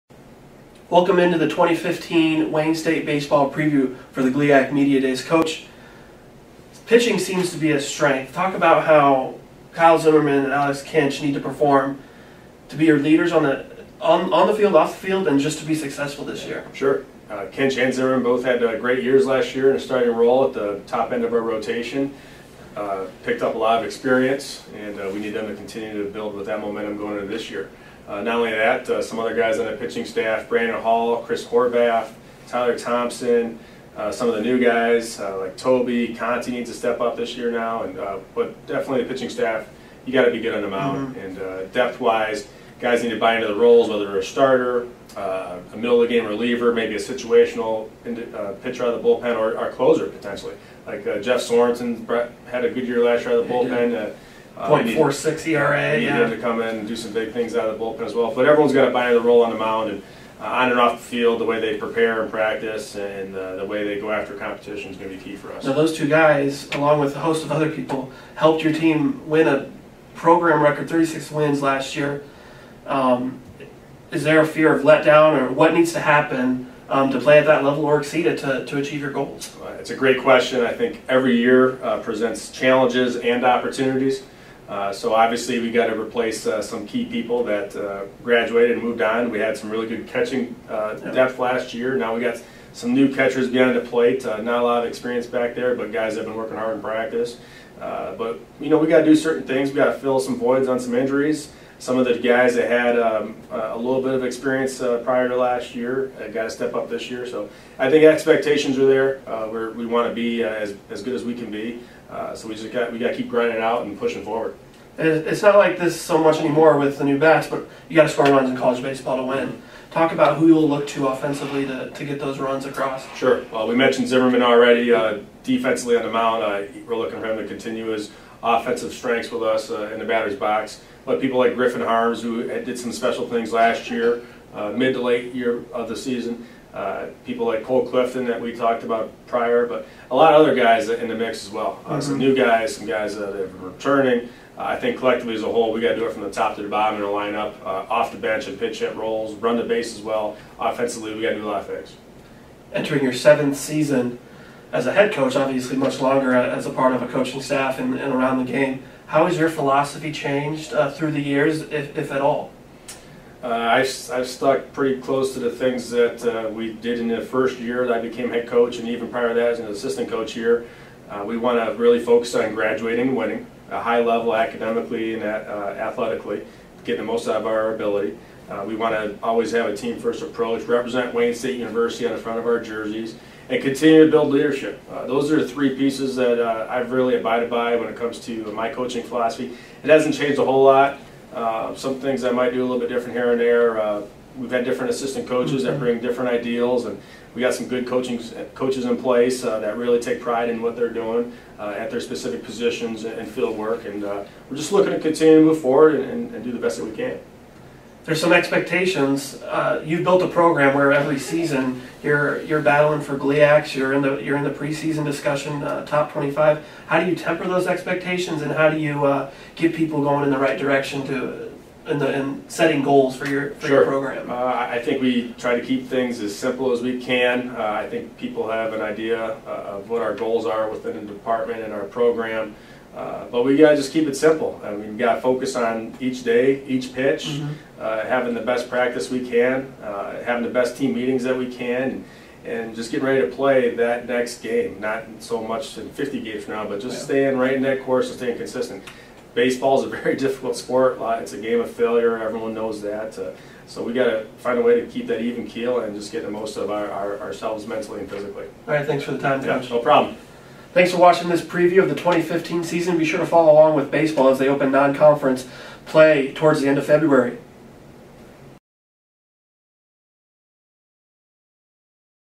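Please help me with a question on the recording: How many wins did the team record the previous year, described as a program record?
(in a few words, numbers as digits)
36.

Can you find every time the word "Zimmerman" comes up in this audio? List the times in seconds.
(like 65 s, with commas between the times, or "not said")
9 s, 17 s, 124 s.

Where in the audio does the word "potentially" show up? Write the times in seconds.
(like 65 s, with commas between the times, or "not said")
50 s.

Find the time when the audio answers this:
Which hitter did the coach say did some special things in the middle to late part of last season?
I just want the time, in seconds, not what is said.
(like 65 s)
131 s.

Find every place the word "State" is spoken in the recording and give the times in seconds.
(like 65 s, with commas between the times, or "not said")
2 s, 181 s.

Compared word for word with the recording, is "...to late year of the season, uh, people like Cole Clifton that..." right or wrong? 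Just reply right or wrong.
right.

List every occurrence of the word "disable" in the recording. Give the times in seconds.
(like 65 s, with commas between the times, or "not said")
not said.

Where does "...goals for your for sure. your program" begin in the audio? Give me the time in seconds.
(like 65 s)
222 s.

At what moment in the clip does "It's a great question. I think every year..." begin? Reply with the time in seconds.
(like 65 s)
79 s.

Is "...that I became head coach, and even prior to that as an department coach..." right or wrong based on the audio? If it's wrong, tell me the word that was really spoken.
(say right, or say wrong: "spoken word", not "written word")
wrong: "assistant", not "department".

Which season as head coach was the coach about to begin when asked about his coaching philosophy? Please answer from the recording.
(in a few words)
Seventh.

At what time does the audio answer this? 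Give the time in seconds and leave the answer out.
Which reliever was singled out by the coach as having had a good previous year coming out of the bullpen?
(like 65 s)
51 s.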